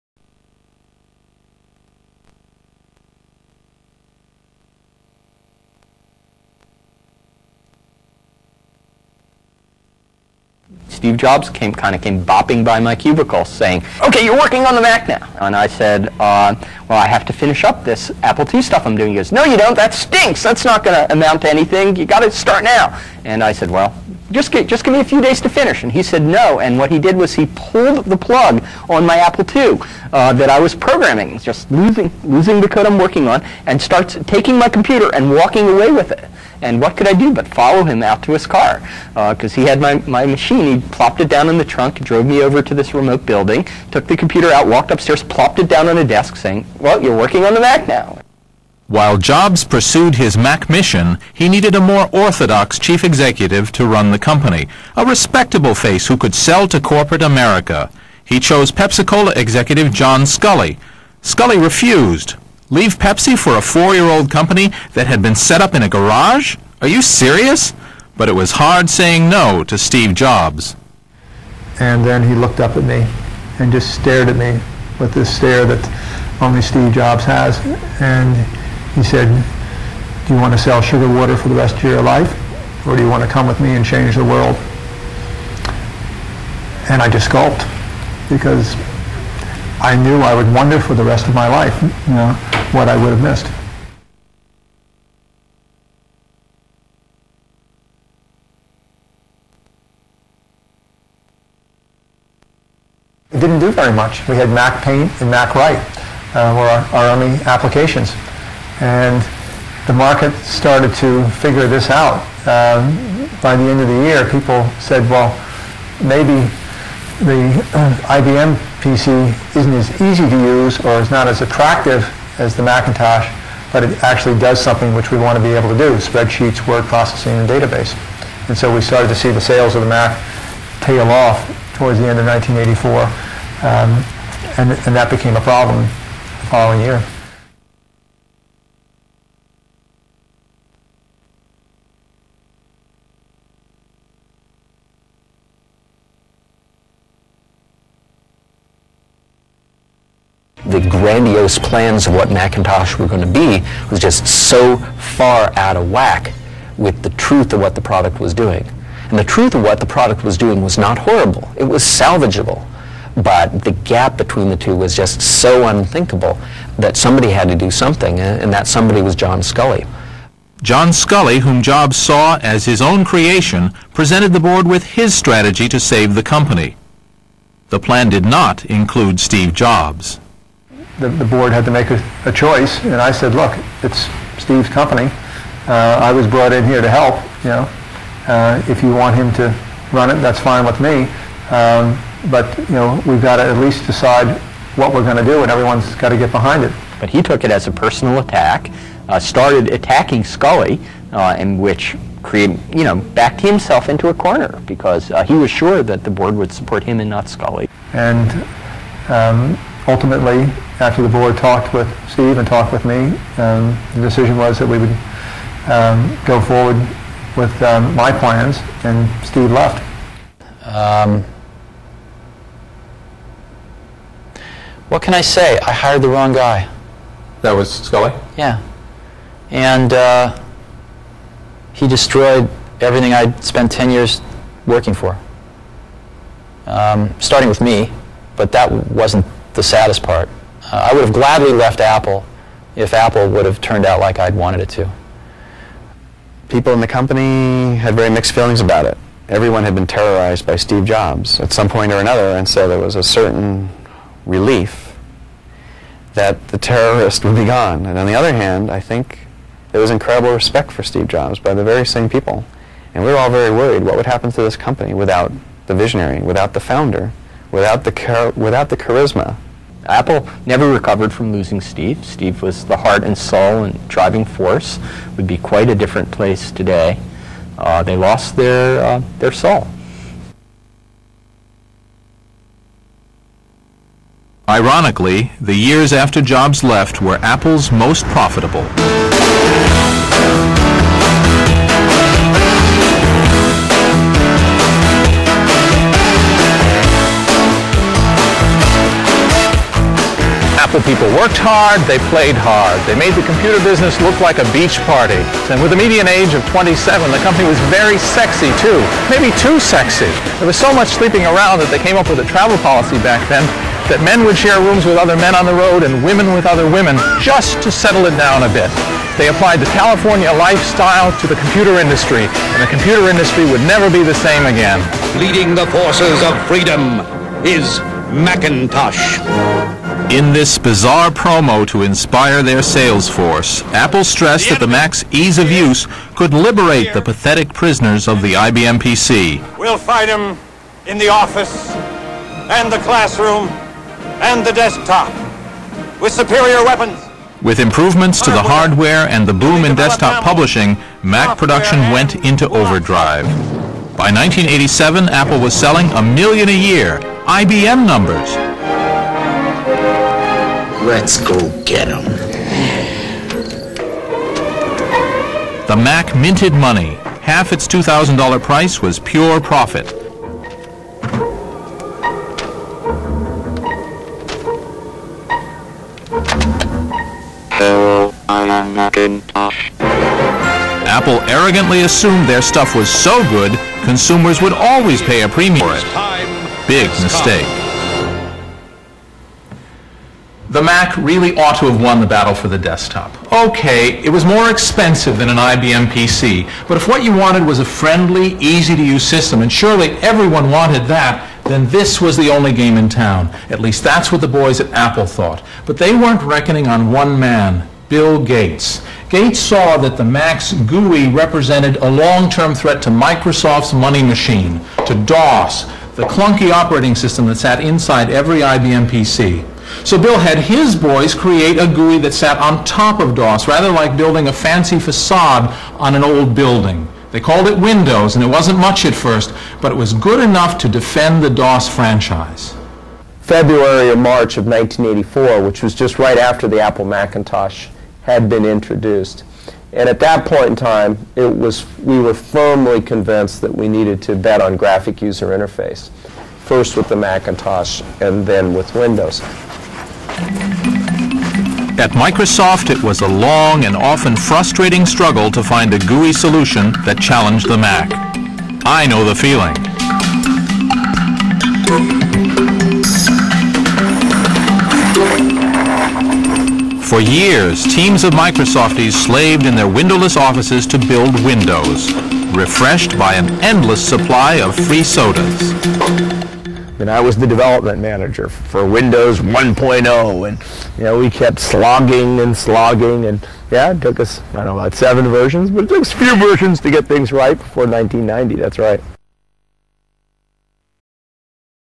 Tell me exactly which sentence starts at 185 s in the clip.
Uh, I was brought in here to help, you know.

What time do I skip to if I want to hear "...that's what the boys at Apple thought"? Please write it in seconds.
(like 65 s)
403 s.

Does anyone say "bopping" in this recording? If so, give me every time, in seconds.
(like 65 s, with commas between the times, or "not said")
12 s.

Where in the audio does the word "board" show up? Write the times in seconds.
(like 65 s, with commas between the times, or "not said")
174 s, 181 s, 206 s, 211 s.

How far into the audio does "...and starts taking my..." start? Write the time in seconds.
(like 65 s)
33 s.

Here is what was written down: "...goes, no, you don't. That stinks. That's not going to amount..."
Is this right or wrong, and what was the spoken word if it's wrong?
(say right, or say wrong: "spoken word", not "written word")
right.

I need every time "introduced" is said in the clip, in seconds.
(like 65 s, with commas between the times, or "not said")
438 s.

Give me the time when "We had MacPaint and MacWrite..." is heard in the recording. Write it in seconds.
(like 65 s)
104 s.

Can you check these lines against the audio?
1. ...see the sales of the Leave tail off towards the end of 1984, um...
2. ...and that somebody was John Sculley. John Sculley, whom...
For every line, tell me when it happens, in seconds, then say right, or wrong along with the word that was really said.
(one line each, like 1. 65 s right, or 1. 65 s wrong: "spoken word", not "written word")
1. 129 s wrong: "Mac", not "Leave"
2. 168 s right.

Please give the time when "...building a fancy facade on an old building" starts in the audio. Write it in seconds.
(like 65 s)
423 s.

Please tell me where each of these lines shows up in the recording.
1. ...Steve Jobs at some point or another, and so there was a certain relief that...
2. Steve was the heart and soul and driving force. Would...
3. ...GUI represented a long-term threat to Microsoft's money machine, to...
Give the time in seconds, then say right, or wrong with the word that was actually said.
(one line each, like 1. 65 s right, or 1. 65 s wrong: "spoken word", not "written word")
1. 250 s right
2. 272 s right
3. 410 s right.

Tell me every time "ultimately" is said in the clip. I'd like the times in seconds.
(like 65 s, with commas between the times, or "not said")
209 s.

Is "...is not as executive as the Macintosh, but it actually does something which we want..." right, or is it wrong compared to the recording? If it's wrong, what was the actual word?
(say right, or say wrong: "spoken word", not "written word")
wrong: "attractive", not "executive".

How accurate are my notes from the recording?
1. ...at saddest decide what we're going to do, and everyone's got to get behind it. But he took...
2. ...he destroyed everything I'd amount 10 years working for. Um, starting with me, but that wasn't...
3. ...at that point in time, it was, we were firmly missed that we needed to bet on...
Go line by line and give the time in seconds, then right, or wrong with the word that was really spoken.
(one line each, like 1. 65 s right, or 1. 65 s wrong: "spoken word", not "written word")
1. 193 s wrong: "least", not "saddest"
2. 231 s wrong: "spent", not "amount"
3. 439 s wrong: "convinced", not "missed".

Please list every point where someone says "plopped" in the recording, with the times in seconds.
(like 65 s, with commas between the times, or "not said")
40 s, 45 s.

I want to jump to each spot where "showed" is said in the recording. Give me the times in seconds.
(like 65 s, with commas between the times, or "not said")
not said.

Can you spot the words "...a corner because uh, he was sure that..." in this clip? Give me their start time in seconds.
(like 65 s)
204 s.